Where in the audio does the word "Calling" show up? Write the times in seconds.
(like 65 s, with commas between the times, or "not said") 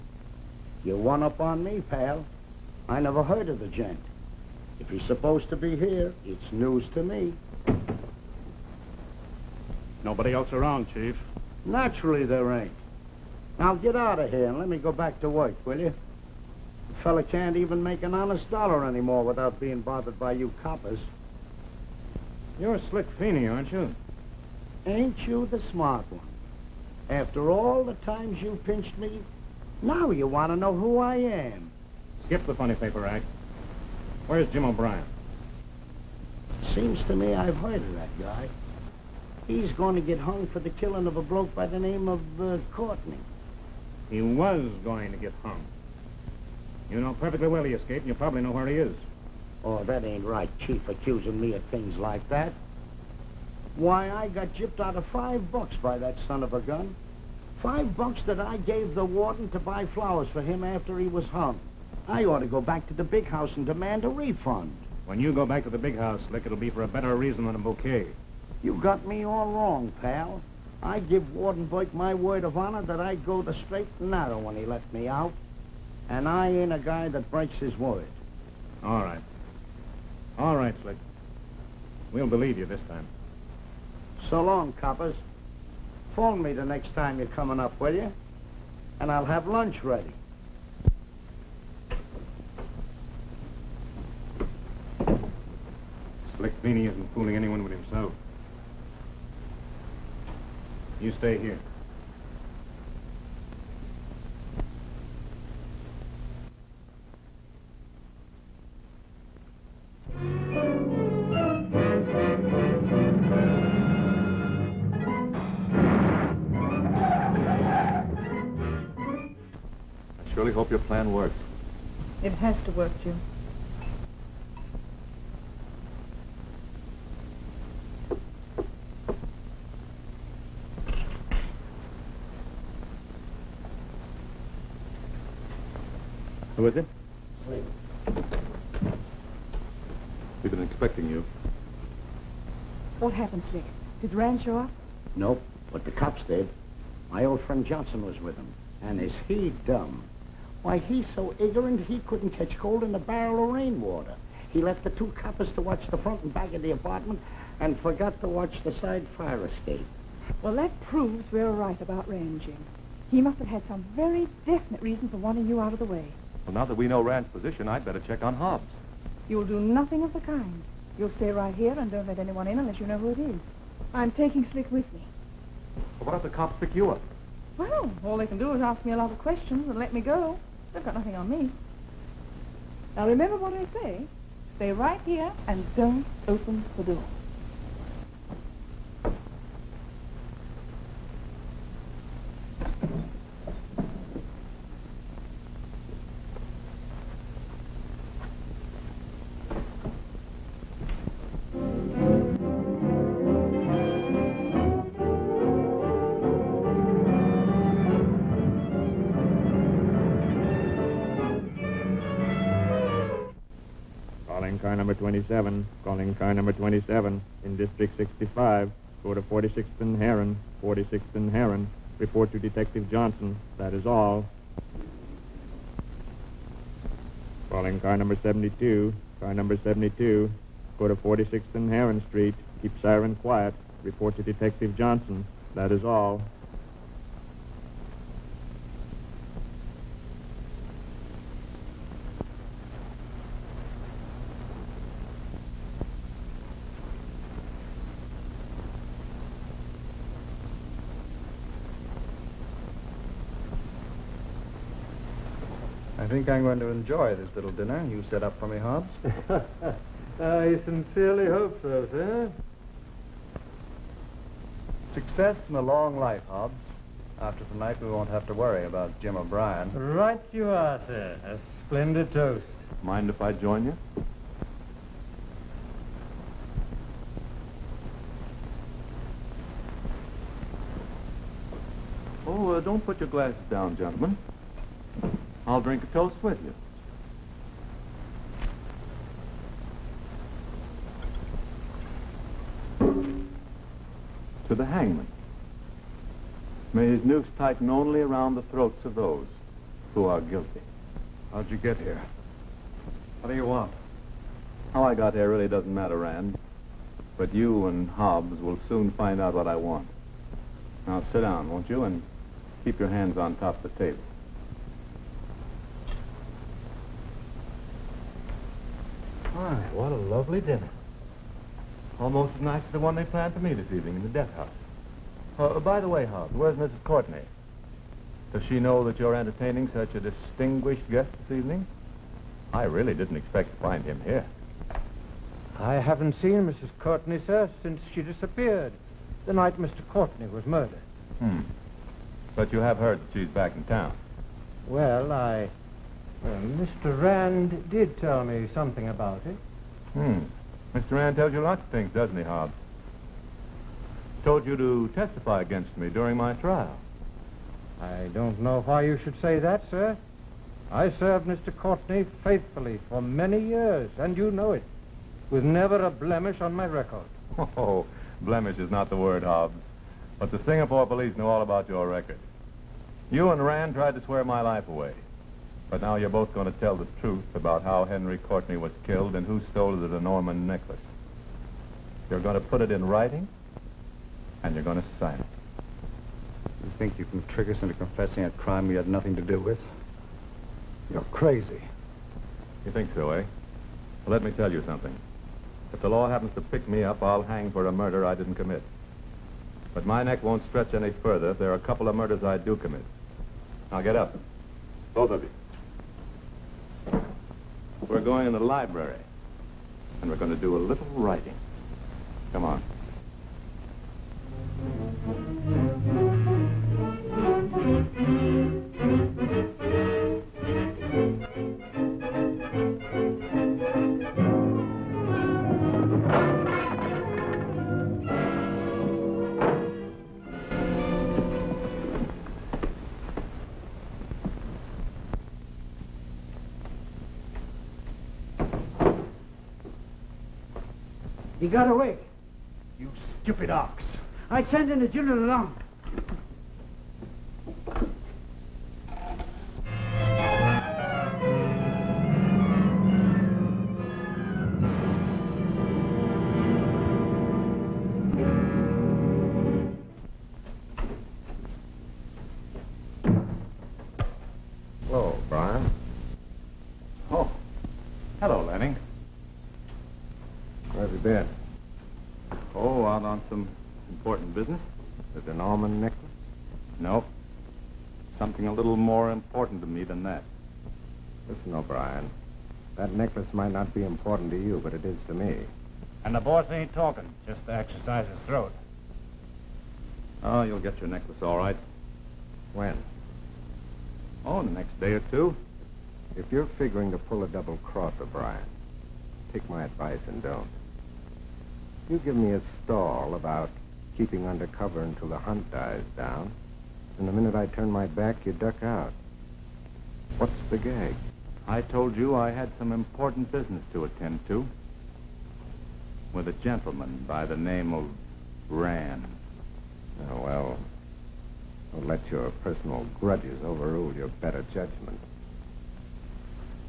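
215 s, 227 s.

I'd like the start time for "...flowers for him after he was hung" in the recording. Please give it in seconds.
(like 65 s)
59 s.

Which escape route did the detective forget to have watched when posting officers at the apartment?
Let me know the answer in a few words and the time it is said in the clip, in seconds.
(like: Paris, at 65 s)
the side fire escape, at 158 s.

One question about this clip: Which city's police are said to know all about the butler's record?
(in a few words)
Singapore.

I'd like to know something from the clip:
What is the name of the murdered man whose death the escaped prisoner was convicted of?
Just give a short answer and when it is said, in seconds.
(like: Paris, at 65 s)
Henry Courtney, at 377 s.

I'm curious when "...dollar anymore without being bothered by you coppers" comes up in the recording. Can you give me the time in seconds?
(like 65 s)
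18 s.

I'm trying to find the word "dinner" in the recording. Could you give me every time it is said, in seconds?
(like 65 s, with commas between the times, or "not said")
257 s, 320 s.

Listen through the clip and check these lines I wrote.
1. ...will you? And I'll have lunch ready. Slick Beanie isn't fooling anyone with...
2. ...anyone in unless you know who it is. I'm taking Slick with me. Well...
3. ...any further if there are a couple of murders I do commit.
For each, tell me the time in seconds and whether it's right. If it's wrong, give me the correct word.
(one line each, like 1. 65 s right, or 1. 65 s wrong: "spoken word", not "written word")
1. 87 s right
2. 172 s right
3. 400 s right.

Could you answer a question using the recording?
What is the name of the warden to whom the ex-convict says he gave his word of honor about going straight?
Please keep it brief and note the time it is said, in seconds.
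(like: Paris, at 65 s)
Warden Burke, at 71 s.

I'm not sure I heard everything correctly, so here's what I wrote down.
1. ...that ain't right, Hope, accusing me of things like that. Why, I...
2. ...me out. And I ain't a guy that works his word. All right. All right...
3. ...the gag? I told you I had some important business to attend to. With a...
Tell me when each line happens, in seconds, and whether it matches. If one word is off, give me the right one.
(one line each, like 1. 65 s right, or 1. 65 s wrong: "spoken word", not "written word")
1. 49 s wrong: "Chief", not "Hope"
2. 74 s wrong: "breaks", not "works"
3. 510 s right.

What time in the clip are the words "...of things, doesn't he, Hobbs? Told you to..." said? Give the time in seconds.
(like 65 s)
351 s.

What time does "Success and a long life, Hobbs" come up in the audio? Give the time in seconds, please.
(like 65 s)
264 s.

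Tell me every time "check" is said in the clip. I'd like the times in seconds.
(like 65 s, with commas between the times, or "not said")
168 s.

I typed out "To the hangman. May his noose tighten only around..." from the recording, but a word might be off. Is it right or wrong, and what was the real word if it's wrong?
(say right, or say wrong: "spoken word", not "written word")
right.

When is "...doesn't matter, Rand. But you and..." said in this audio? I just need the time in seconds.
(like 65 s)
305 s.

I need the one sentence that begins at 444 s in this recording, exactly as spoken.
I sent in a general alarm.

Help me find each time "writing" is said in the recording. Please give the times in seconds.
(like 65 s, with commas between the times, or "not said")
382 s, 410 s.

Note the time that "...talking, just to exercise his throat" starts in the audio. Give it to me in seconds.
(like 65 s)
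486 s.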